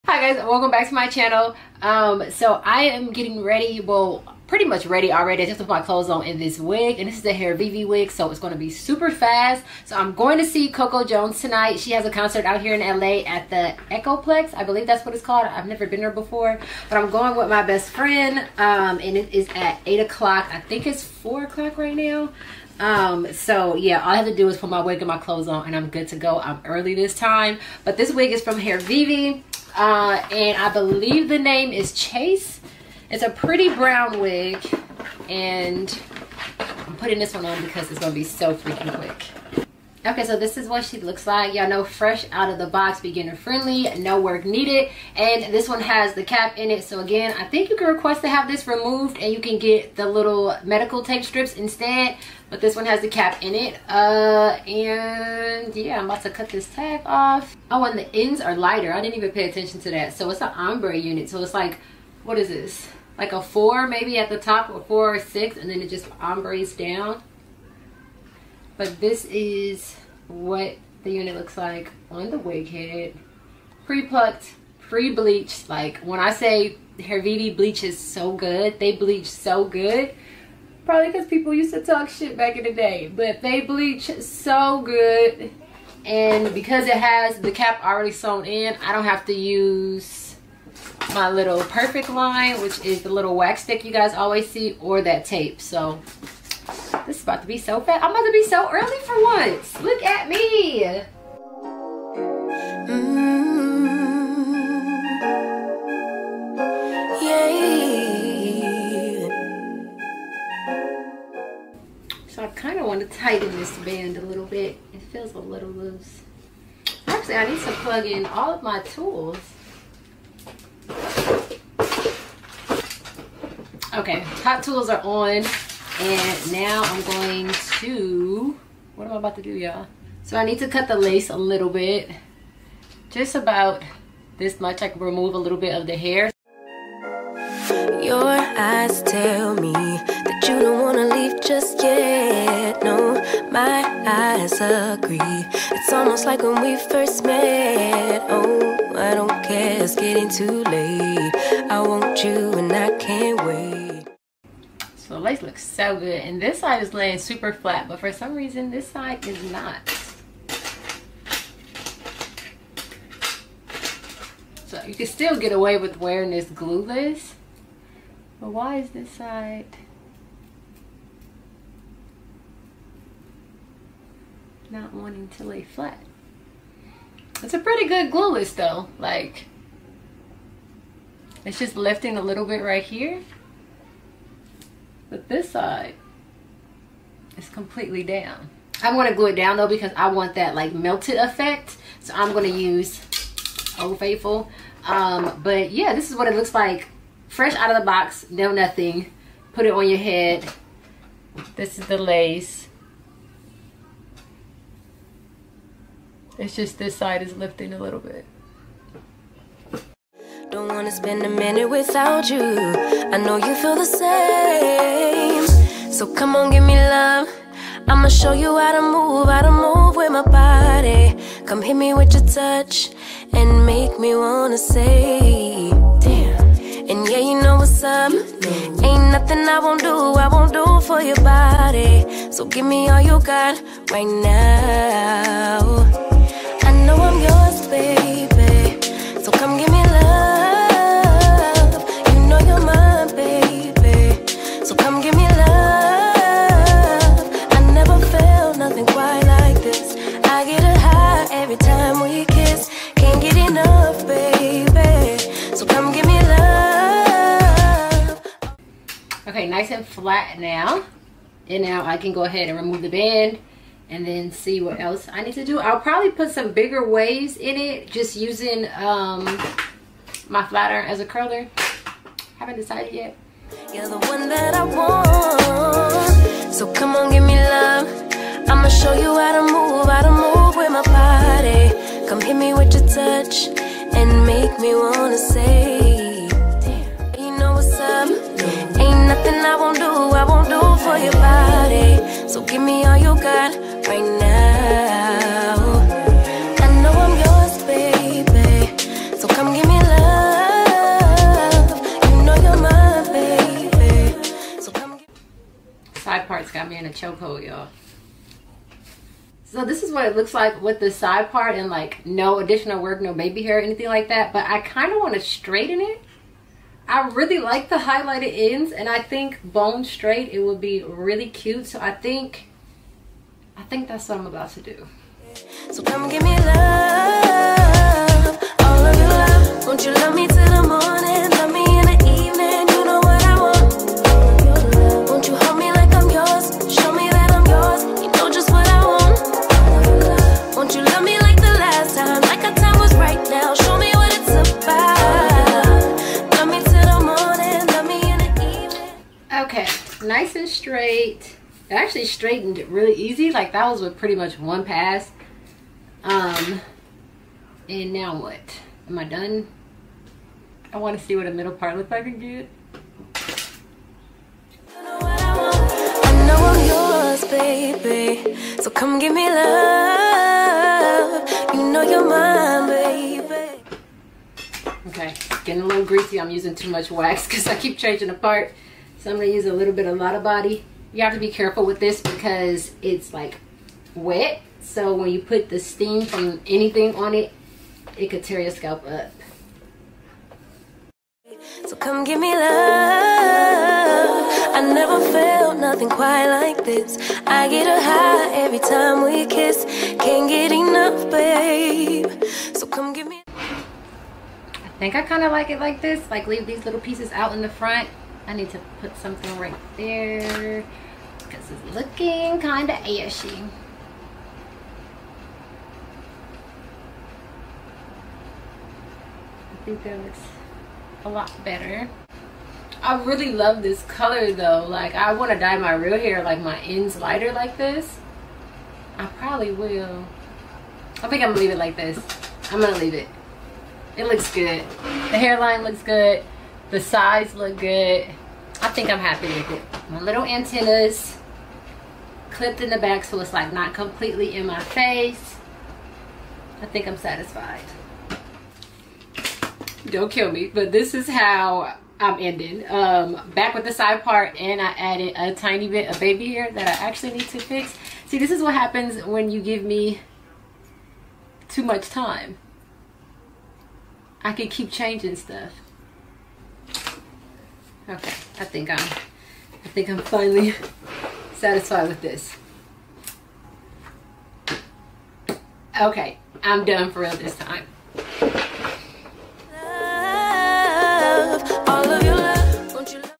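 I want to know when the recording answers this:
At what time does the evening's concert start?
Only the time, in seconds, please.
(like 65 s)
19 s.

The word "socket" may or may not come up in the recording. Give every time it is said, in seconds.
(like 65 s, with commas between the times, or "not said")
not said.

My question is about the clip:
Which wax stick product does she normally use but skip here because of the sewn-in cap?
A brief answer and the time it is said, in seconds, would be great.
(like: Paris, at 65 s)
Perfect line, at 91 s.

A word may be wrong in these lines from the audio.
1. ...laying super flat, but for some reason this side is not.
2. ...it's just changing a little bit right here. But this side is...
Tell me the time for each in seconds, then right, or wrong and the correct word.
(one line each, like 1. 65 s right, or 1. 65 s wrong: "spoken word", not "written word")
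1. 156 s right
2. 181 s wrong: "lifting", not "changing".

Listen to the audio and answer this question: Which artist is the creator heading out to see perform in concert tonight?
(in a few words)
Coco Jones.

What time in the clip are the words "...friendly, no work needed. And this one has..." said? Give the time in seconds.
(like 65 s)
43 s.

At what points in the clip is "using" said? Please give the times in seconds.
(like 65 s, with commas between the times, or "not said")
268 s, 376 s.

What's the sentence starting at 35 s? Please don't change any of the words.
And I'm putting this one on because it's going to be so freaking quick.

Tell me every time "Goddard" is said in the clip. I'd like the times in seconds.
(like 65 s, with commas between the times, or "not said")
not said.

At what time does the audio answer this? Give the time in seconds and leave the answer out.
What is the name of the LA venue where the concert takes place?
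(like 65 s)
13 s.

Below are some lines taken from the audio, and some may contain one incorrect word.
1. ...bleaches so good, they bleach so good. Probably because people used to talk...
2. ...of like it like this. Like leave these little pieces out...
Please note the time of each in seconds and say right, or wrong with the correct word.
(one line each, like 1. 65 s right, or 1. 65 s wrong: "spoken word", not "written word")
1. 77 s right
2. 405 s right.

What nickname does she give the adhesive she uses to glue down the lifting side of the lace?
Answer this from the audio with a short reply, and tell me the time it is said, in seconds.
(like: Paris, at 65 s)
Old Faithful, at 193 s.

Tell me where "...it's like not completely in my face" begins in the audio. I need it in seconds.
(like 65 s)
443 s.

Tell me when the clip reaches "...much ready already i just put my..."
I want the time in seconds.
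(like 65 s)
4 s.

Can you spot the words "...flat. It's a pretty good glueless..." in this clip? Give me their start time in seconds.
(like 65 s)
175 s.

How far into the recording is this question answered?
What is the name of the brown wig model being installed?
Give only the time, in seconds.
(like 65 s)
31 s.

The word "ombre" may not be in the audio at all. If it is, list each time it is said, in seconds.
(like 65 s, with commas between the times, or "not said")
60 s, 66 s.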